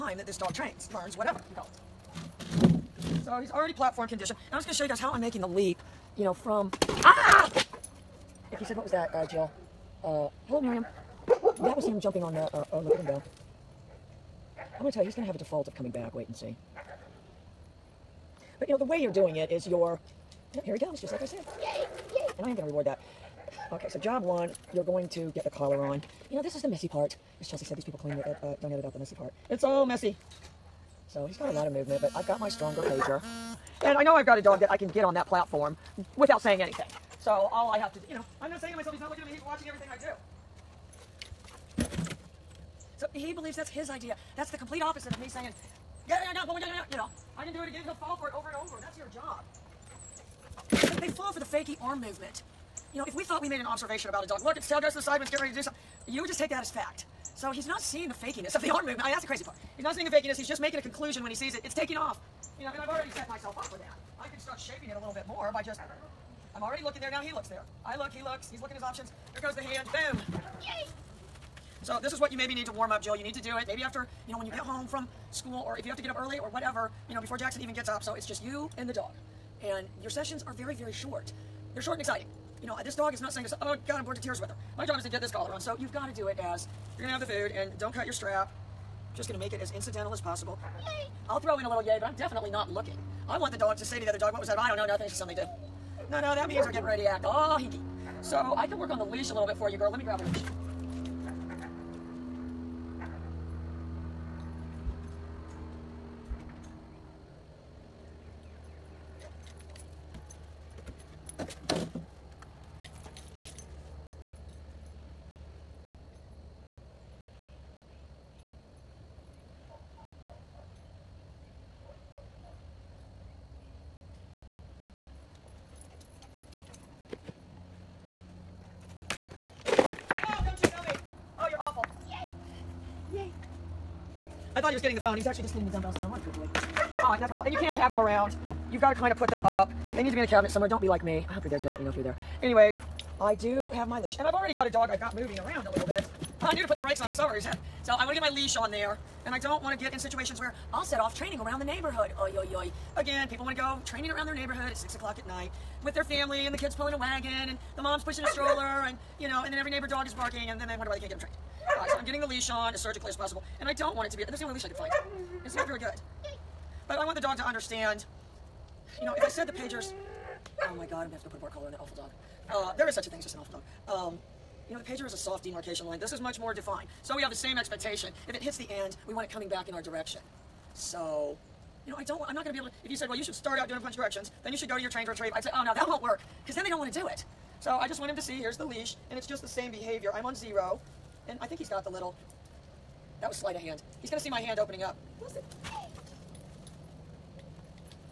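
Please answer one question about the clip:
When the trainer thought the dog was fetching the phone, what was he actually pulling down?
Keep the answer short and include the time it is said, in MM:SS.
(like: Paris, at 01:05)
The dumbbells, at 02:15.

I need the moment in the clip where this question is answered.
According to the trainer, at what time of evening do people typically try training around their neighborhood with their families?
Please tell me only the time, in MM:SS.
02:34.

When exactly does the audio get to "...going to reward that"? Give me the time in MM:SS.
00:22.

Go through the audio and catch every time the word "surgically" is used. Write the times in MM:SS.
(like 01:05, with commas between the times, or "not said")
02:42.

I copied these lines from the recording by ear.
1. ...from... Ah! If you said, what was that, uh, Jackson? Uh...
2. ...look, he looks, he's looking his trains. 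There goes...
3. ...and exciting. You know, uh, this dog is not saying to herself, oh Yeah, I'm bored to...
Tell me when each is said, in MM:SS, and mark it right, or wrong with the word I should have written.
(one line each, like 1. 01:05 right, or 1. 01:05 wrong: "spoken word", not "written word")
1. 00:06 wrong: "Jill", not "Jackson"
2. 01:07 wrong: "options", not "trains"
3. 01:21 wrong: "God", not "Yeah".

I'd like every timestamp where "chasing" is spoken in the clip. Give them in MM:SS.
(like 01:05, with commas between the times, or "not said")
not said.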